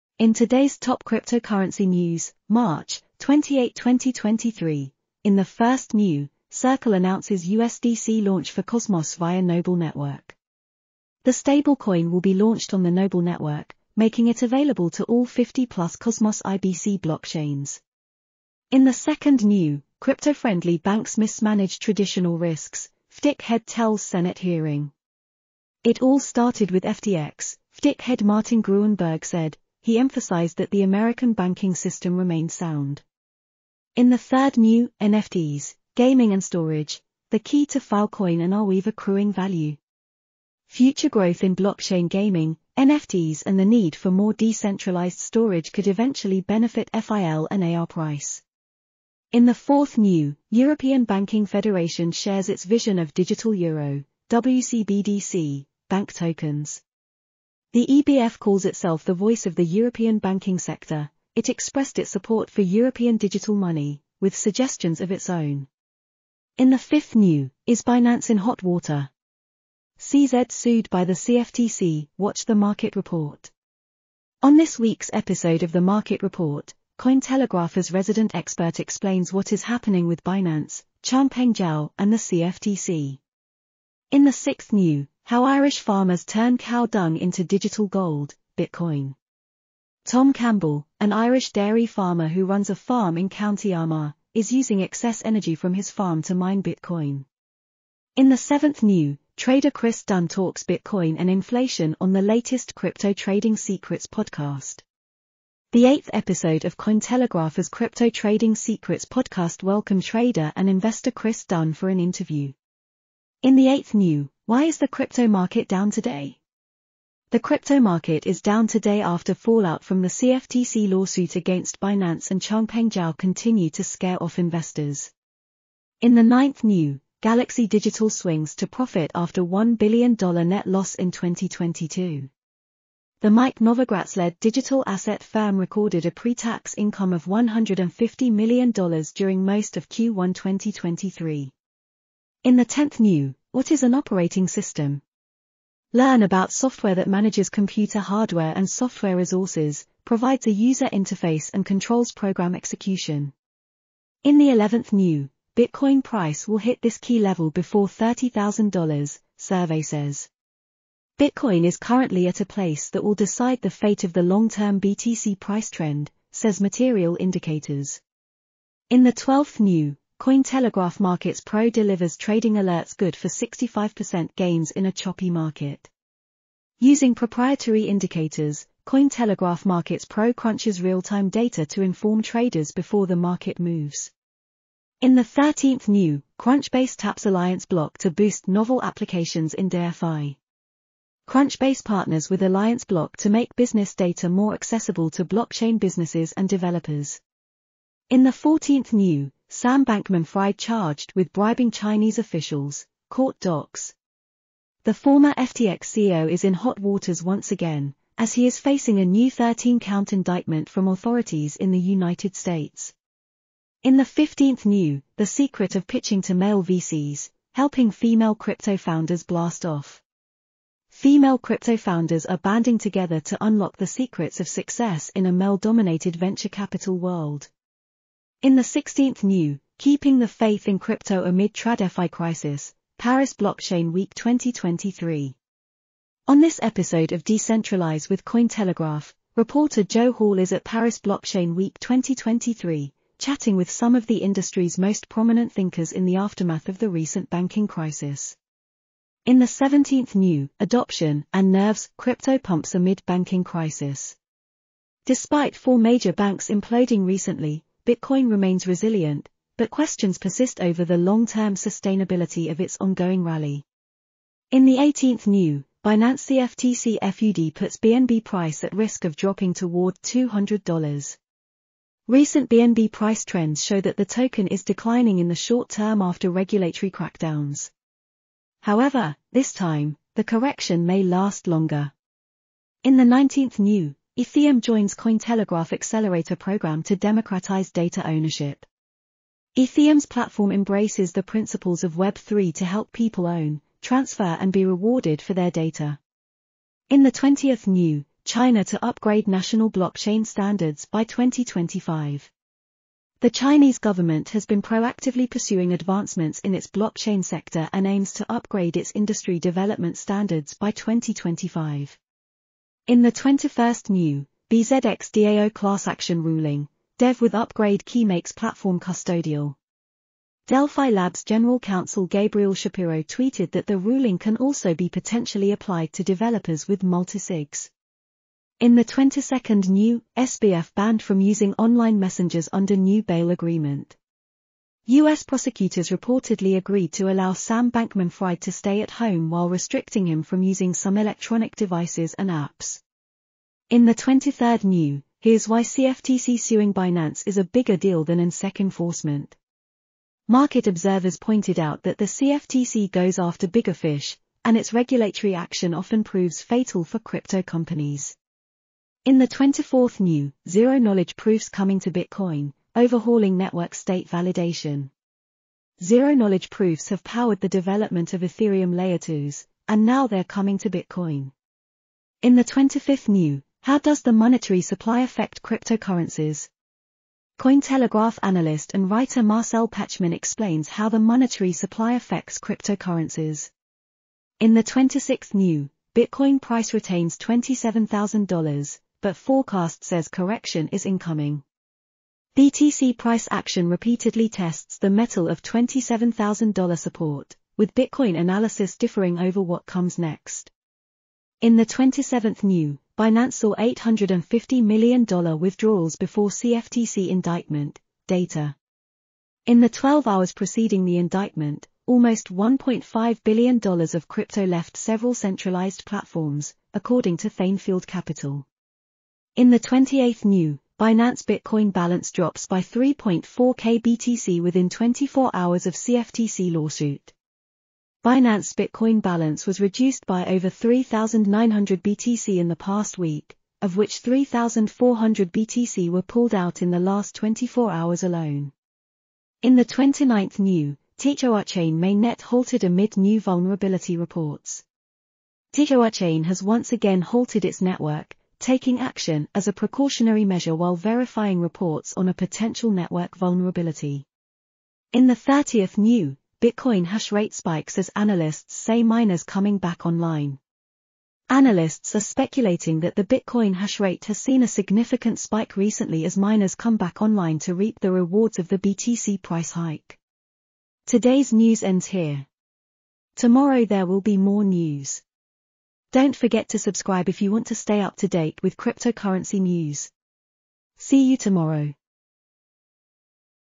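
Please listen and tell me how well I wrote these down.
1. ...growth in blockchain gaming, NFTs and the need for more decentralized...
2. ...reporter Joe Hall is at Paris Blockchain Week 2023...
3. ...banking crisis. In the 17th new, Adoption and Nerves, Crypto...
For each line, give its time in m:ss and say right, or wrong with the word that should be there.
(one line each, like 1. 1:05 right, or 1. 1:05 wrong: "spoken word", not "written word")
1. 0:41 right
2. 3:59 right
3. 4:07 right.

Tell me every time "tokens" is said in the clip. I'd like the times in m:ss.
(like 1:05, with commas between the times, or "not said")
0:56, 4:34.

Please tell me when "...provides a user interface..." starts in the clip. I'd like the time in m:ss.
2:30.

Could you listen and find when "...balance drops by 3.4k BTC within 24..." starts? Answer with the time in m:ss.
7:01.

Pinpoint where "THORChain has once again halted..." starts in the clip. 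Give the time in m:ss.
7:25.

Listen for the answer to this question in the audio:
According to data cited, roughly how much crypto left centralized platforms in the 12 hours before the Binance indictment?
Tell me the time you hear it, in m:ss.
6:52.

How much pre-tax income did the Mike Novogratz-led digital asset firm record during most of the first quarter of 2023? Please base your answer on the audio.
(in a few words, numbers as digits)
$150 million.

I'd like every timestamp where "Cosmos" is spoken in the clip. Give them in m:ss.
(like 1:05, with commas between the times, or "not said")
0:08, 0:15.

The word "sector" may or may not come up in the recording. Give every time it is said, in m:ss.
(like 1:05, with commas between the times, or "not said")
1:00, 5:07.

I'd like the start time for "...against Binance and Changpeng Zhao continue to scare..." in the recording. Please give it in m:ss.
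2:01.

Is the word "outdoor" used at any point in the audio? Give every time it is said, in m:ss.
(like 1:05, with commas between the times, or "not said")
not said.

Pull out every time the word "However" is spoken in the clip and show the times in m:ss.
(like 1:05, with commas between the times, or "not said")
4:38.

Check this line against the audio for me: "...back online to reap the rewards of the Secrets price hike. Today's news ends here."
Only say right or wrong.
wrong.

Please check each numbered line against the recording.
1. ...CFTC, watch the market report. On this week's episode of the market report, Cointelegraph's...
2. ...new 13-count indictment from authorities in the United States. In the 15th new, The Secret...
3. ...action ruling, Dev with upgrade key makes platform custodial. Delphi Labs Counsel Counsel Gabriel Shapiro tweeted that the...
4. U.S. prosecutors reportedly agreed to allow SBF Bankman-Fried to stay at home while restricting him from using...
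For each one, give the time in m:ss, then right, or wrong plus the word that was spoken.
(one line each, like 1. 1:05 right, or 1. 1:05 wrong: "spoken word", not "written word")
1. 1:11 right
2. 3:29 right
3. 5:15 wrong: "General", not "Counsel"
4. 5:34 wrong: "Sam", not "SBF".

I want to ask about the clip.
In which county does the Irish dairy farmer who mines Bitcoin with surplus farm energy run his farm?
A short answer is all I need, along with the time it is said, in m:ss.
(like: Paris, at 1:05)
County Armagh, at 1:33.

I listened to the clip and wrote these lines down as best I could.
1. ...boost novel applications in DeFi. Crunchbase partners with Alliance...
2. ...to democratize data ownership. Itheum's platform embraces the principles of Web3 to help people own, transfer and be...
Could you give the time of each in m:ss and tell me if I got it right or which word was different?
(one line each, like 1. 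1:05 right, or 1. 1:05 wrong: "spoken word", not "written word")
1. 3:08 right
2. 4:46 right.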